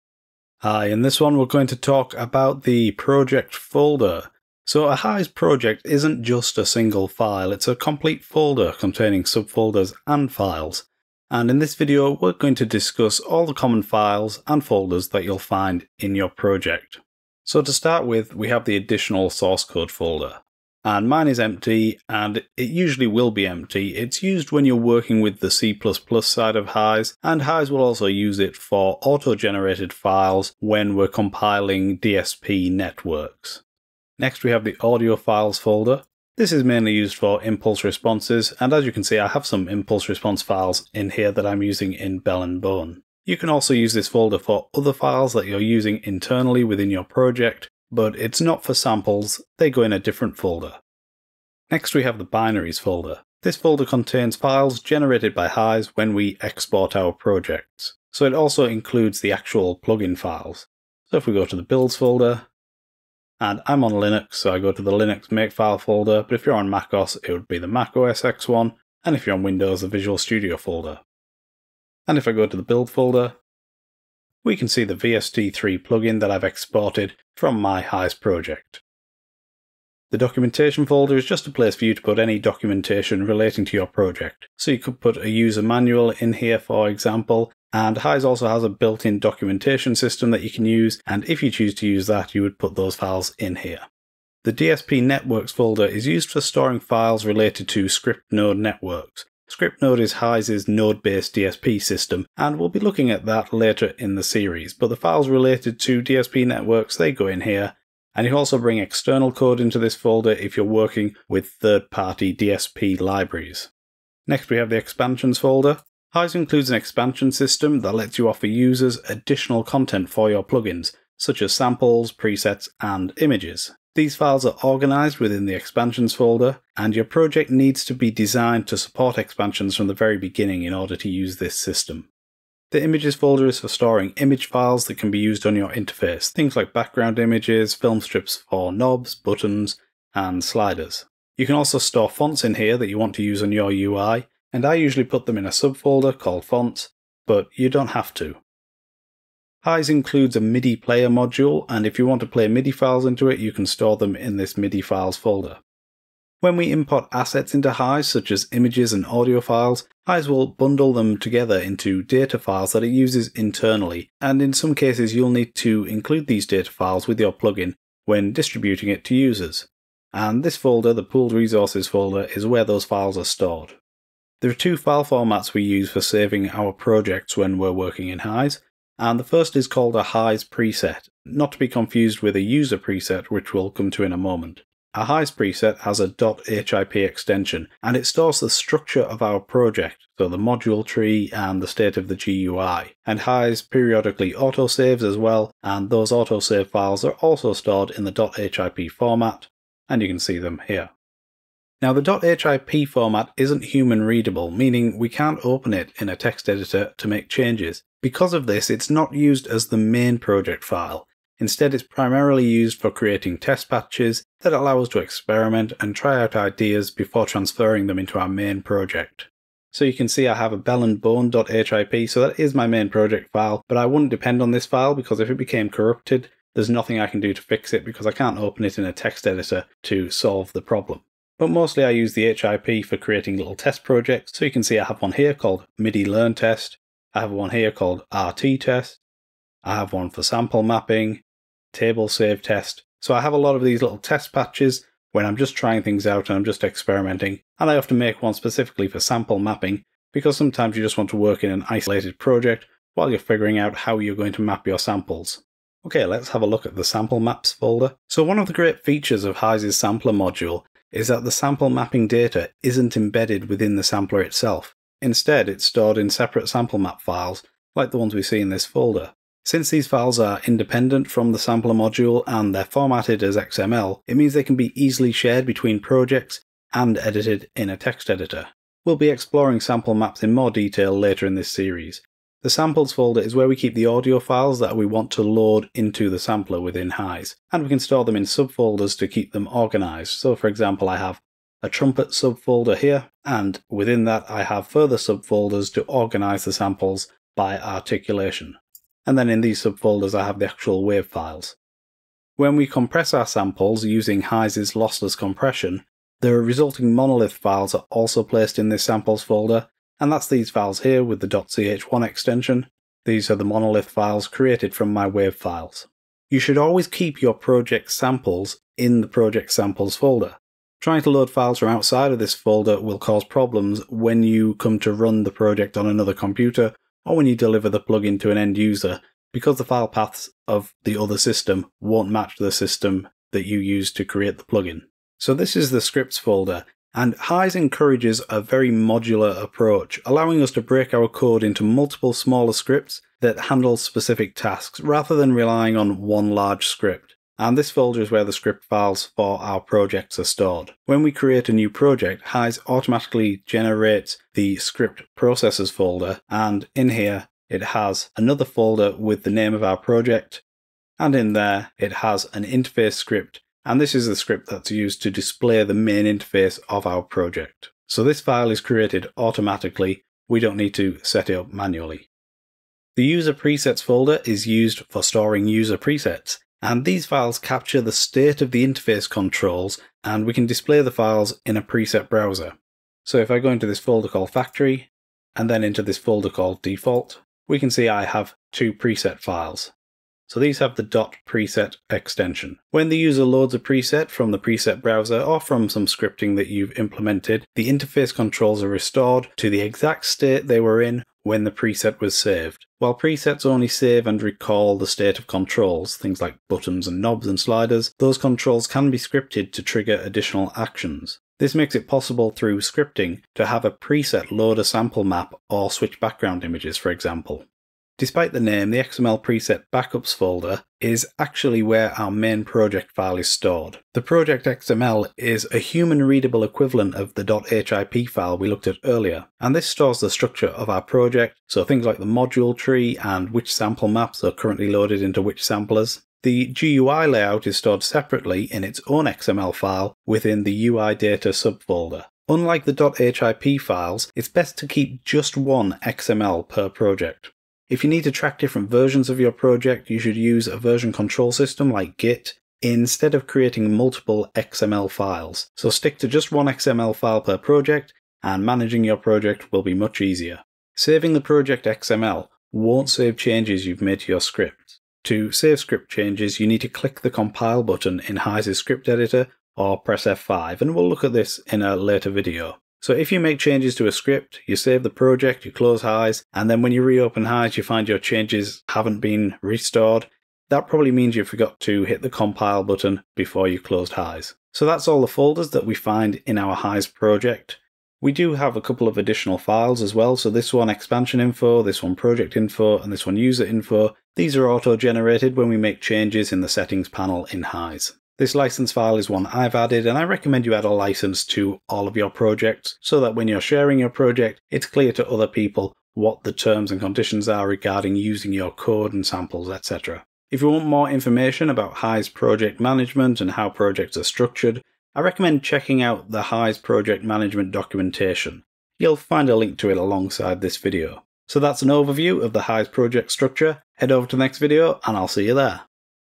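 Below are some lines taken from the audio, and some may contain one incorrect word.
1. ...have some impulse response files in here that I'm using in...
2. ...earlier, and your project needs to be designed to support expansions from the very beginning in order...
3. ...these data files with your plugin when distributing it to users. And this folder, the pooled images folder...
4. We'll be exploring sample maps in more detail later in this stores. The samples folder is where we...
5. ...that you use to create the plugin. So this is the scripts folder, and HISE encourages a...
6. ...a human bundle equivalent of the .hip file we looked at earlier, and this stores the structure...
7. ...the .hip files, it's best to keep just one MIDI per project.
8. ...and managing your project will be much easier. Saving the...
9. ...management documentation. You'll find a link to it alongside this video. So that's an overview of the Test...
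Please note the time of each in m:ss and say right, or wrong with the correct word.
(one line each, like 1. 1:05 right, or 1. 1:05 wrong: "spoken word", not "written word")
1. 0:39 right
2. 2:06 wrong: "folder", not "earlier"
3. 2:46 wrong: "resources", not "images"
4. 4:38 wrong: "series", not "stores"
5. 5:33 right
6. 7:05 wrong: "readable", not "bundle"
7. 7:22 wrong: "XML", not "MIDI"
8. 7:38 right
9. 8:37 wrong: "HISE", not "Test".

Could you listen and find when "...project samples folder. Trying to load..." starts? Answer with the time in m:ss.
5:19.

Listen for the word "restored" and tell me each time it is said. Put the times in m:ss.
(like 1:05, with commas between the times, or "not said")
6:38, 7:59.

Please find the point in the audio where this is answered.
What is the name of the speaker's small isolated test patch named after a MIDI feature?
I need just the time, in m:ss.
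3:55.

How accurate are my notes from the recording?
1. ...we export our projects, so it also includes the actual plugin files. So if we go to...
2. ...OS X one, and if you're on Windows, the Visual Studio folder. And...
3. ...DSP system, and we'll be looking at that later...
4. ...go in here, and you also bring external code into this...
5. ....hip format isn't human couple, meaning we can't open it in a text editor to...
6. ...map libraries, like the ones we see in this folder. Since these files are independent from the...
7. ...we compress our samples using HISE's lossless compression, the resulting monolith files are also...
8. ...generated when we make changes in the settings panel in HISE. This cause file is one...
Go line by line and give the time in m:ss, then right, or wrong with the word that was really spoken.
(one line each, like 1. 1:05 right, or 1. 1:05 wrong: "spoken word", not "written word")
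1. 0:56 right
2. 1:07 right
3. 1:41 right
4. 1:47 right
5. 3:22 wrong: "readable", not "couple"
6. 4:26 wrong: "files", not "libraries"
7. 5:02 right
8. 8:14 wrong: "license", not "cause".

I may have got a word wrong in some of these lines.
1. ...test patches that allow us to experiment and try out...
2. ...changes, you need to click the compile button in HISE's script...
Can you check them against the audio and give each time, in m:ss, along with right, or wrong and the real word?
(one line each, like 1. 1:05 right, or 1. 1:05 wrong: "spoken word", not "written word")
1. 3:33 right
2. 7:45 right.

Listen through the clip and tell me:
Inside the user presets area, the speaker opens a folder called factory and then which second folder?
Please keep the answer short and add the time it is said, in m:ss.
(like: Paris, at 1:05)
default, at 6:26.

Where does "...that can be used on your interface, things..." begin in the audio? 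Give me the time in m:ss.
2:14.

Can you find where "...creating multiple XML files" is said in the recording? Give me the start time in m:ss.
7:33.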